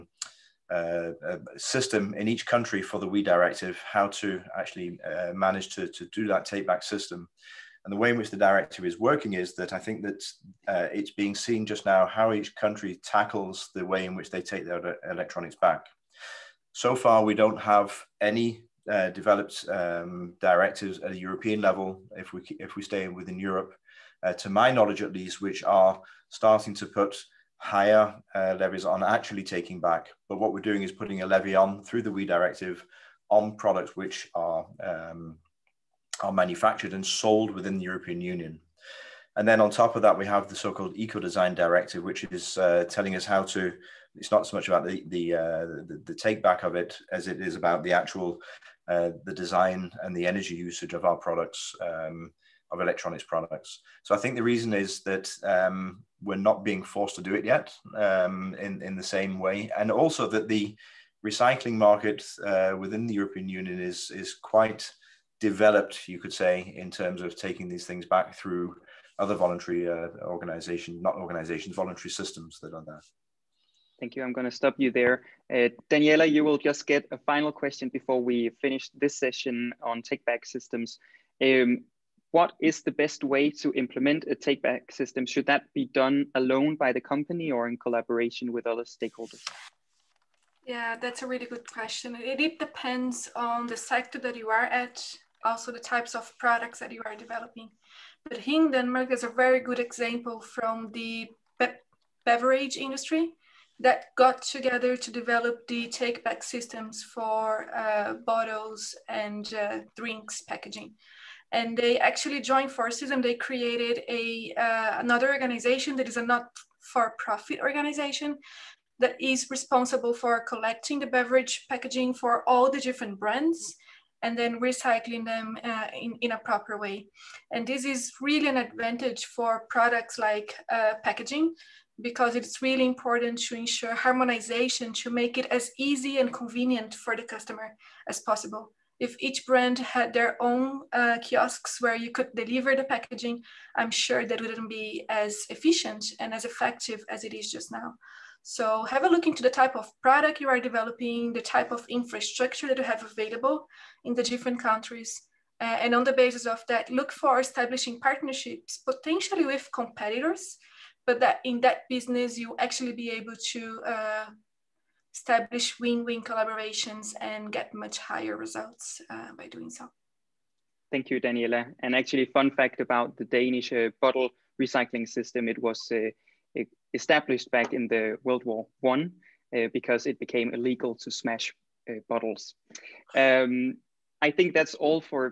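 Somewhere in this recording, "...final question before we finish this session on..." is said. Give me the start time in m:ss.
1:17.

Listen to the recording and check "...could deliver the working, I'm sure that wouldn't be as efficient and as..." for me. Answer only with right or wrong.
wrong.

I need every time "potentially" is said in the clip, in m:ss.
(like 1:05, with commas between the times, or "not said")
2:38.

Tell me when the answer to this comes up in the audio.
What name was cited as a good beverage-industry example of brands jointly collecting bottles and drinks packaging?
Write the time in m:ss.
1:38.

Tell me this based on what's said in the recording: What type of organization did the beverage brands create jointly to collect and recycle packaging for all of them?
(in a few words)
not for profit organization.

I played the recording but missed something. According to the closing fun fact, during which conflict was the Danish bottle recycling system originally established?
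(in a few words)
World War One.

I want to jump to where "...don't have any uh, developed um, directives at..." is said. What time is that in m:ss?
0:17.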